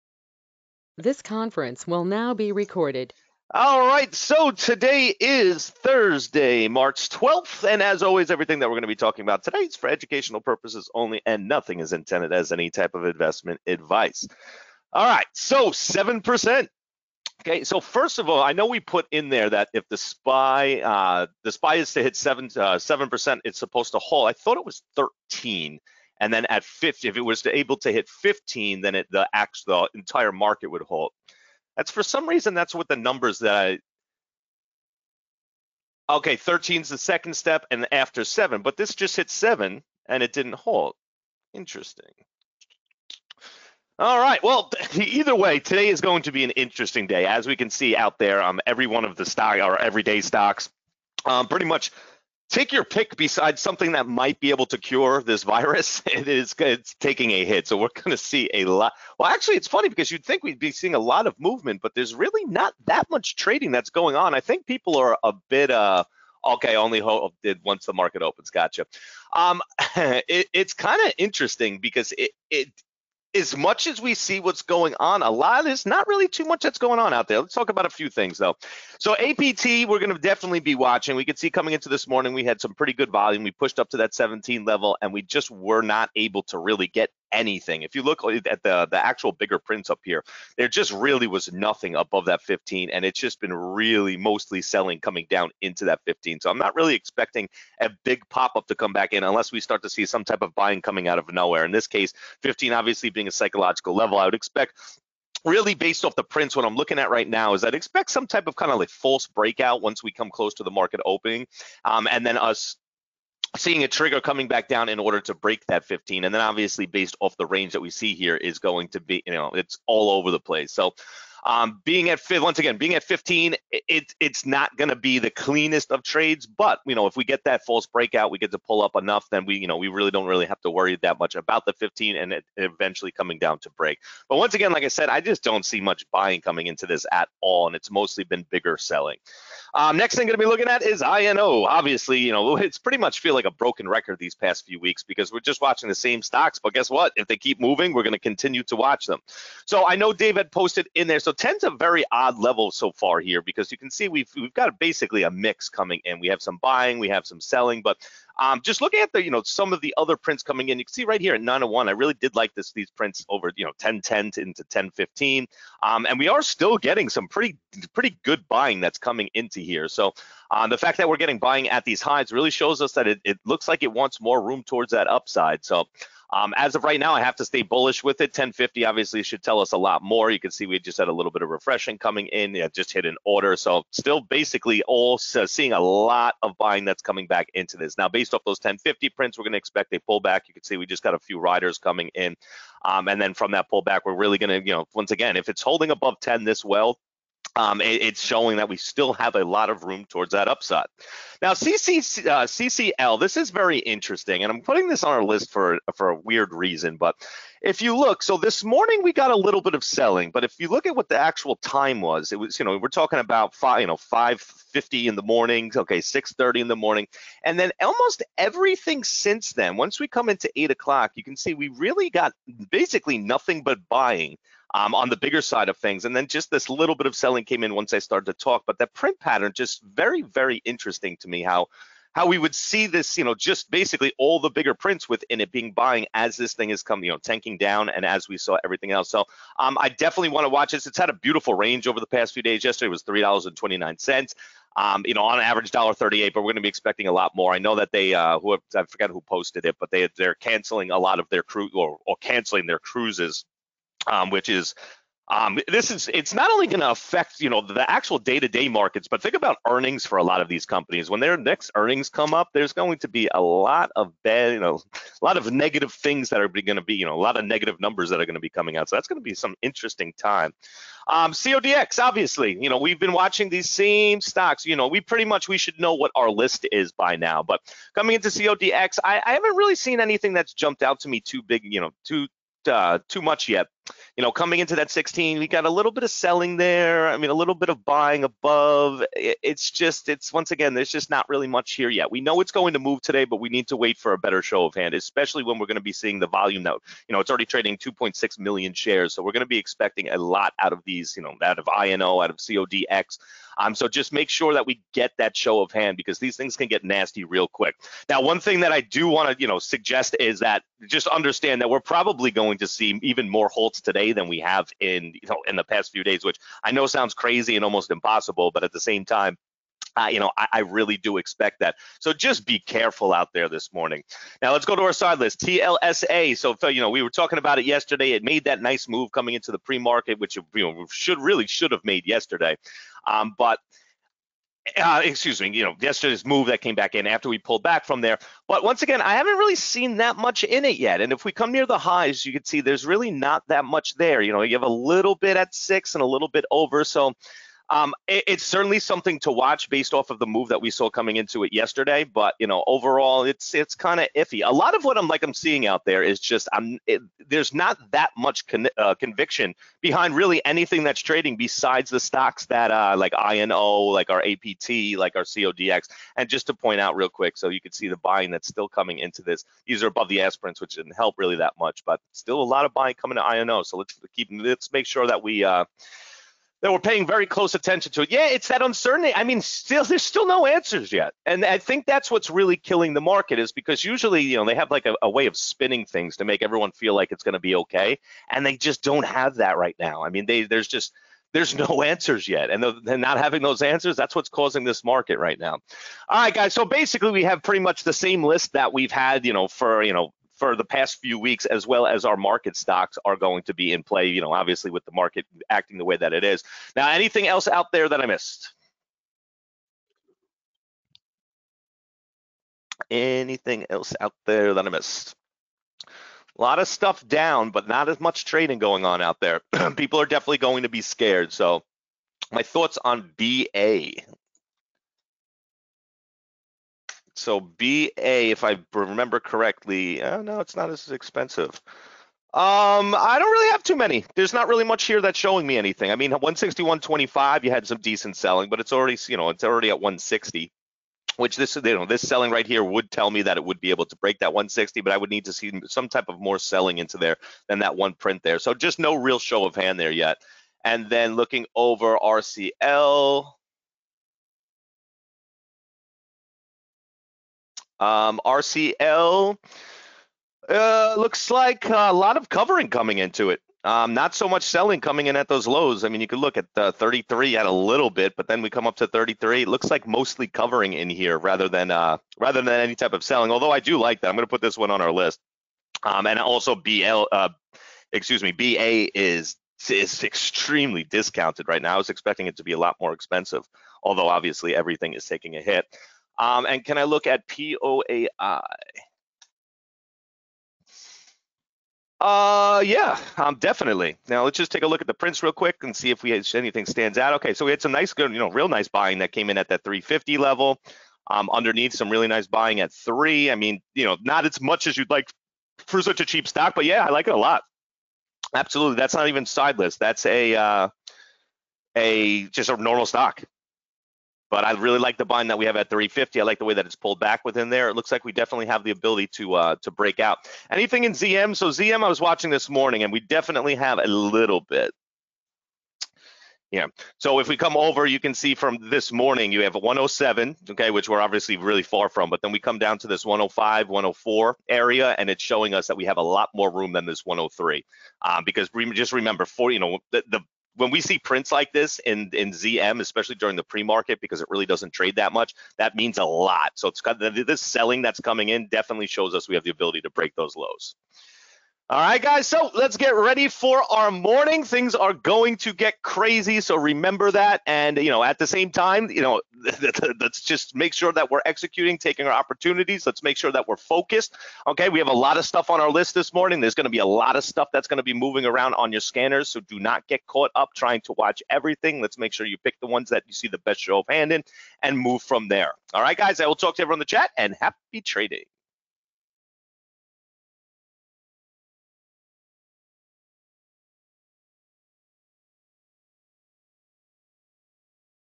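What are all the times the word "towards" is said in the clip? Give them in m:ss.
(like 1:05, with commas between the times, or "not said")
2:54, 3:20.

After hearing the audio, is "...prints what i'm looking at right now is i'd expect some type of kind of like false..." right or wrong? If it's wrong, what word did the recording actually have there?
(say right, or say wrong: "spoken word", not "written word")
right.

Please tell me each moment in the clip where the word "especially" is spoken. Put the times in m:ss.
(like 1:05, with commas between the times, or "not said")
4:54, 9:02.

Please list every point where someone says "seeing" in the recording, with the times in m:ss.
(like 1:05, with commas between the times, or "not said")
1:00, 1:53, 3:05, 4:55, 5:55.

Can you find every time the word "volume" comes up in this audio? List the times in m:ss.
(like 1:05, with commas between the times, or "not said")
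1:23, 4:56.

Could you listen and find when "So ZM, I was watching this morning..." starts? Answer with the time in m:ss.
8:41.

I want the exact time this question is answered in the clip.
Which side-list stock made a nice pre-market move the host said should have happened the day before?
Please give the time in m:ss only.
5:25.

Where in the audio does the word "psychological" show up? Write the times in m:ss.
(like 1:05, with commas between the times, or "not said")
1:43.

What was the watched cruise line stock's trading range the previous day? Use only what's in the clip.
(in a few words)
$3.29.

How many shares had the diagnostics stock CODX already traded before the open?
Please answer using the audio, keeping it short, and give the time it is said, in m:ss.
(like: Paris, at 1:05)
2.6 million, at 4:57.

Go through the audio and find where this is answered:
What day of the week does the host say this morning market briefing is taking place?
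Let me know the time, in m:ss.
0:05.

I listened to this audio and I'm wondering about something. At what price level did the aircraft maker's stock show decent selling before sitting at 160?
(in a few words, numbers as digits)
161.25.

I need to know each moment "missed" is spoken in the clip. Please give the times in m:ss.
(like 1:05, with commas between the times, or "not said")
6:48, 6:54.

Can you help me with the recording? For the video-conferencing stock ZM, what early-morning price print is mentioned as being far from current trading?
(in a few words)
107.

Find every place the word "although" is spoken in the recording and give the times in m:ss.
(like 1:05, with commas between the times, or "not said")
7:53, 8:03.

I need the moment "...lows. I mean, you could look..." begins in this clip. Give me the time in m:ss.
7:45.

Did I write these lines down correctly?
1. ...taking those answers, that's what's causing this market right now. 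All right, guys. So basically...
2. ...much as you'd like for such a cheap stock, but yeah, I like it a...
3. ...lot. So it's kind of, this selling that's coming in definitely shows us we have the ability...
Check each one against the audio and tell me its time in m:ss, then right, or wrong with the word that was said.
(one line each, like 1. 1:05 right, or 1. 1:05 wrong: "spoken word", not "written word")
1. 6:33 wrong: "having", not "taking"
2. 8:24 right
3. 9:06 right.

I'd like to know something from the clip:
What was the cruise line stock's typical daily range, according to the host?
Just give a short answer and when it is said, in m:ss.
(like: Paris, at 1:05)
$1.38, at 4:05.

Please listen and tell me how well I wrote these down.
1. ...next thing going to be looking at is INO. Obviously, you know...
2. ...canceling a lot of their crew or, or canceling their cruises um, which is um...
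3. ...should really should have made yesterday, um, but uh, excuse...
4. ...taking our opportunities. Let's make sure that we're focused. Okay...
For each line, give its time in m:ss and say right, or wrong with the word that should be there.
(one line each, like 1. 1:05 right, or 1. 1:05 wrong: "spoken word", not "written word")
1. 2:19 right
2. 4:10 right
3. 5:30 right
4. 9:21 right.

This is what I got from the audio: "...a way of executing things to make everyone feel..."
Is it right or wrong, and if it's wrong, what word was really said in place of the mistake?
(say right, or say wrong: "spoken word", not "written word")
wrong: "spinning", not "executing".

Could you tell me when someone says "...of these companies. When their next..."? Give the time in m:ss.
4:20.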